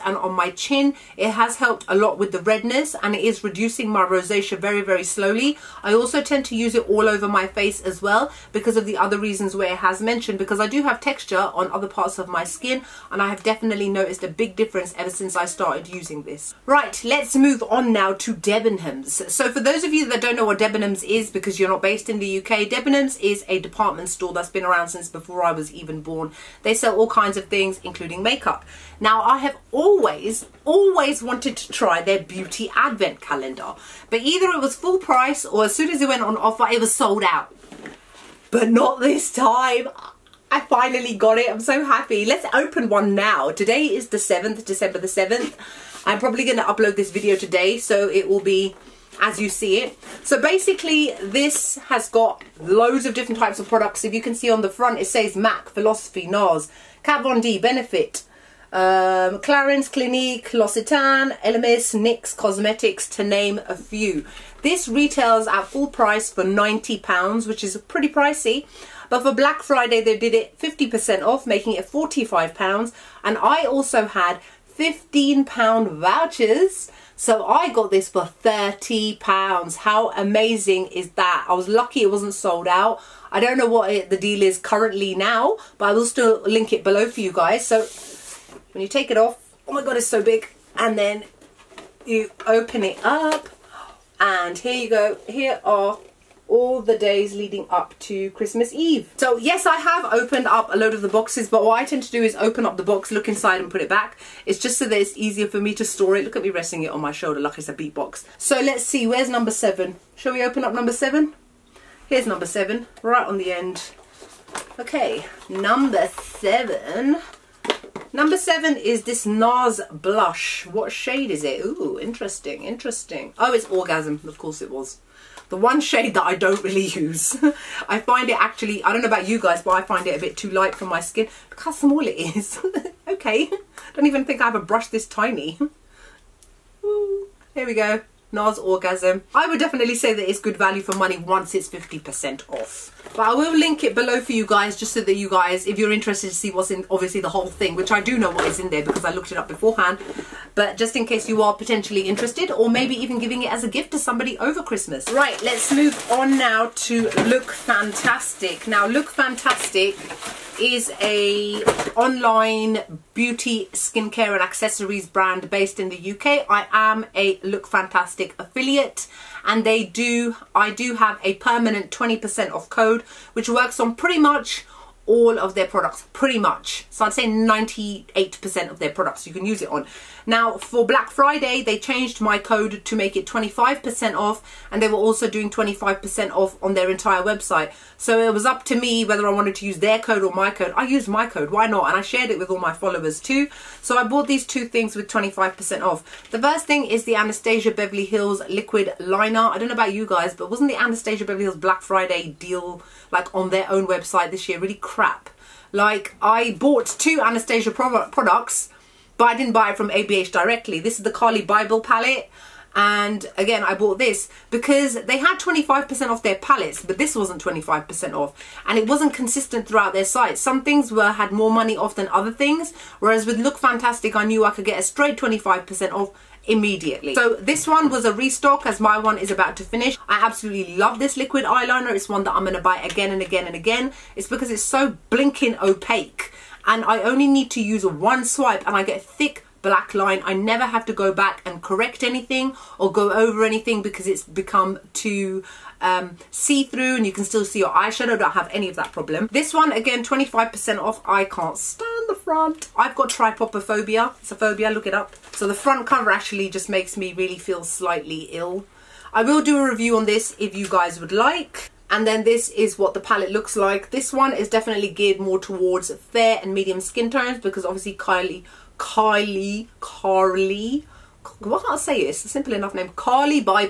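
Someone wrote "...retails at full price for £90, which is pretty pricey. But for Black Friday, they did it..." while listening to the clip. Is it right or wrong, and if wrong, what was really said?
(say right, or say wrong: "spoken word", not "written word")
right.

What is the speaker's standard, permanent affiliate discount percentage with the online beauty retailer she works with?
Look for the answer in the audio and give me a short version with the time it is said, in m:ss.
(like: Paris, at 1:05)
20%, at 2:51.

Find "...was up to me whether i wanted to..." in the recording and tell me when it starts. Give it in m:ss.
3:08.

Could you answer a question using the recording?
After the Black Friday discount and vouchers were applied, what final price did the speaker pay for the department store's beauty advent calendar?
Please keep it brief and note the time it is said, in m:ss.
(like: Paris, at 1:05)
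£30, at 1:18.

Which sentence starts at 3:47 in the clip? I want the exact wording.
So this one was a restock as my one is about to finish.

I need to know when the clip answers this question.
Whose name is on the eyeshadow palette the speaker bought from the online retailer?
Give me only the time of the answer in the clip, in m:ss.
3:31.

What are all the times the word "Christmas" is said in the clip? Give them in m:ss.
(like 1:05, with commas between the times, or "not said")
1:38, 2:34.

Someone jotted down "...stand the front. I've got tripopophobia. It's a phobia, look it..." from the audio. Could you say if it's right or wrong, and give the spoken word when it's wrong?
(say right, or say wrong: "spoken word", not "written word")
right.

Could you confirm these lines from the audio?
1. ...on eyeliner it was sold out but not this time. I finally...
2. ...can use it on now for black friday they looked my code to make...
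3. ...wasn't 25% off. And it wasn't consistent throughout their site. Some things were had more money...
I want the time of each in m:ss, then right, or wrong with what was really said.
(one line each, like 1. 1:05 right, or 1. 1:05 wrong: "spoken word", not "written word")
1. 0:36 wrong: "offer", not "eyeliner"
2. 2:59 wrong: "changed", not "looked"
3. 3:37 right.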